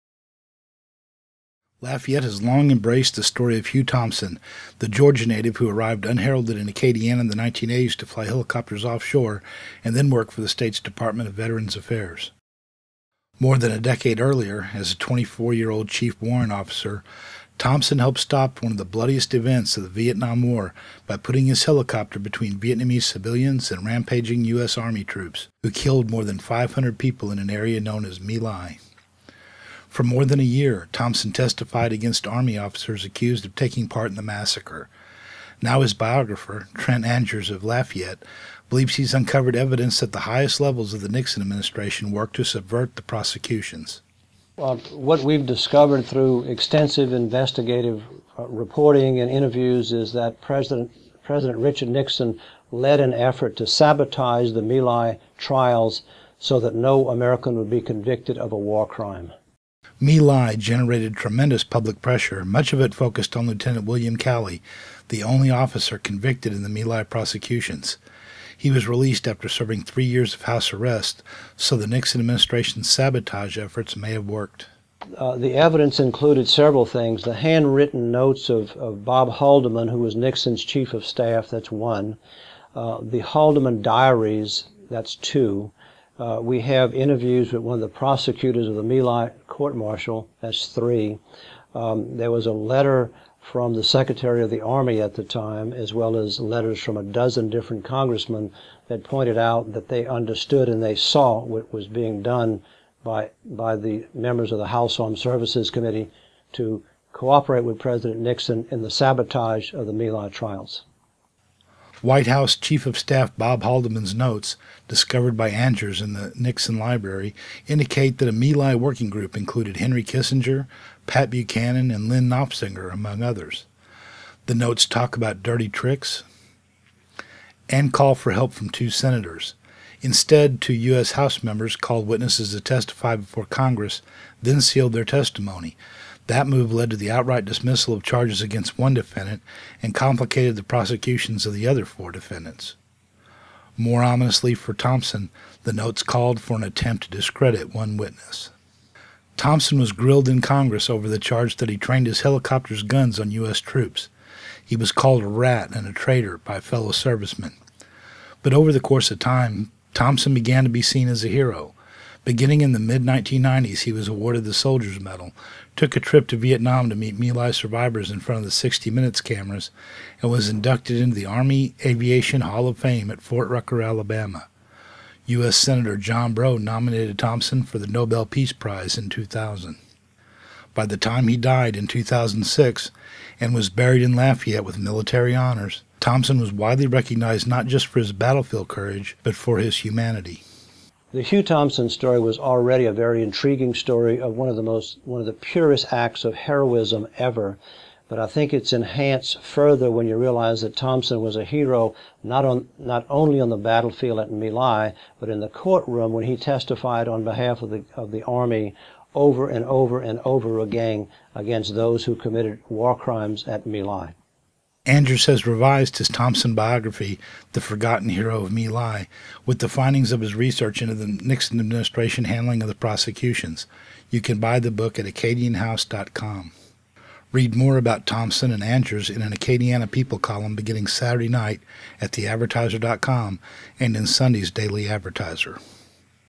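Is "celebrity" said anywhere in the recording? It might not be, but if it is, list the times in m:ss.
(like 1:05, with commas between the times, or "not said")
not said.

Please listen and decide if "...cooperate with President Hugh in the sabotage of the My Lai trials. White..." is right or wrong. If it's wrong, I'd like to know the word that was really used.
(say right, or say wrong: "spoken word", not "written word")
wrong: "Nixon", not "Hugh".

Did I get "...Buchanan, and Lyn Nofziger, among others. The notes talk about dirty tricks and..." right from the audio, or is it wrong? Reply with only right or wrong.
right.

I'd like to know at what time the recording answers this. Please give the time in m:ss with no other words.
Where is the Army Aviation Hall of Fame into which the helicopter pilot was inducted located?
2:53.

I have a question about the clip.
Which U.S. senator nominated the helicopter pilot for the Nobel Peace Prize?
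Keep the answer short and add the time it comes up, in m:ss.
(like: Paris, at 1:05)
John Breaux, at 2:55.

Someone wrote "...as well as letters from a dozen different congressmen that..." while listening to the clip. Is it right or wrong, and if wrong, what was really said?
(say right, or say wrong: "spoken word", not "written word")
right.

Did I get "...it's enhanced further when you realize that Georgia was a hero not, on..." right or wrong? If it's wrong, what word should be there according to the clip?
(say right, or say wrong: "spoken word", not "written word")
wrong: "Thompson", not "Georgia".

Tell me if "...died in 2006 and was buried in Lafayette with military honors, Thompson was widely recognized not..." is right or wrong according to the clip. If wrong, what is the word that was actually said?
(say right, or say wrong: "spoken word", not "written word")
right.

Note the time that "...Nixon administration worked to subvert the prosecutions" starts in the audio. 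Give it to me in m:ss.
0:41.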